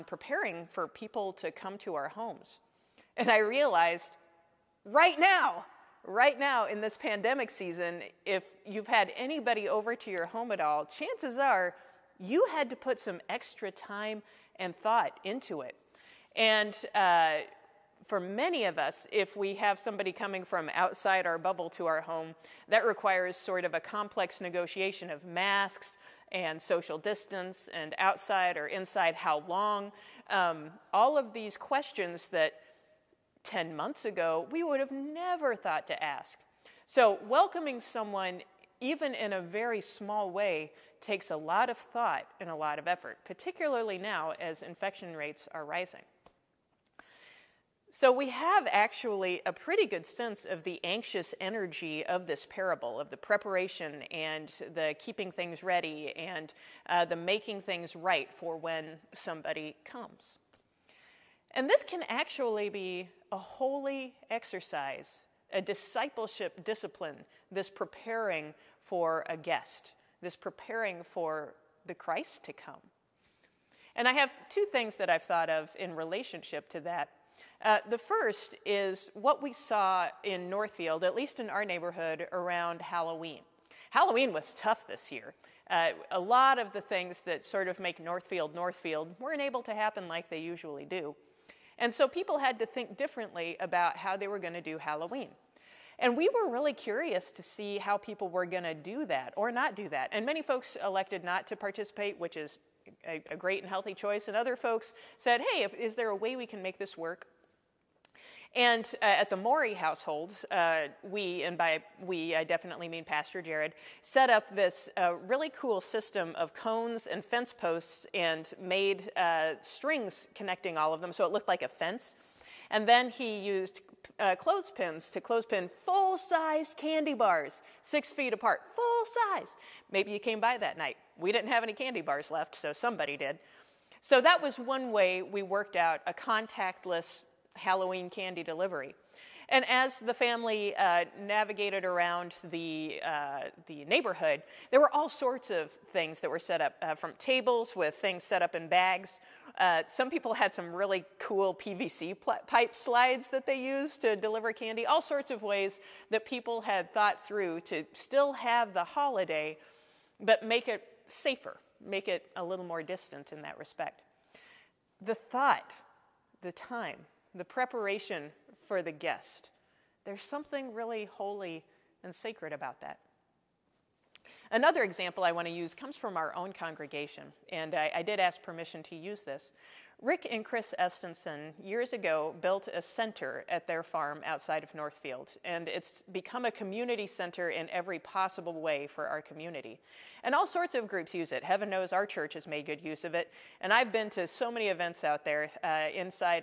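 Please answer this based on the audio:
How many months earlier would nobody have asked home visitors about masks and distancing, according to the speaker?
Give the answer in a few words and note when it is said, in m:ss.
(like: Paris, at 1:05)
10, at 0:33.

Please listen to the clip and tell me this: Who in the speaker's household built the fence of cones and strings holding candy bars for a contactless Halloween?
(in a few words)
Pastor Jared.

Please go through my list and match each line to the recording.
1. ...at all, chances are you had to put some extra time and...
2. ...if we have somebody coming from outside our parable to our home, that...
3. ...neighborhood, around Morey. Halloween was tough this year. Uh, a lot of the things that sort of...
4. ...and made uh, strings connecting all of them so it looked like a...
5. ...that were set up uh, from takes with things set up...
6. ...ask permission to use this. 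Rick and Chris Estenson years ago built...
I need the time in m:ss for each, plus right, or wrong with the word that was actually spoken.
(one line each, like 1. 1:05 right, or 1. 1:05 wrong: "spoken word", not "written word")
1. 0:10 right
2. 0:19 wrong: "bubble", not "parable"
3. 1:21 wrong: "Halloween", not "Morey"
4. 1:58 right
5. 2:26 wrong: "tables", not "takes"
6. 2:58 right.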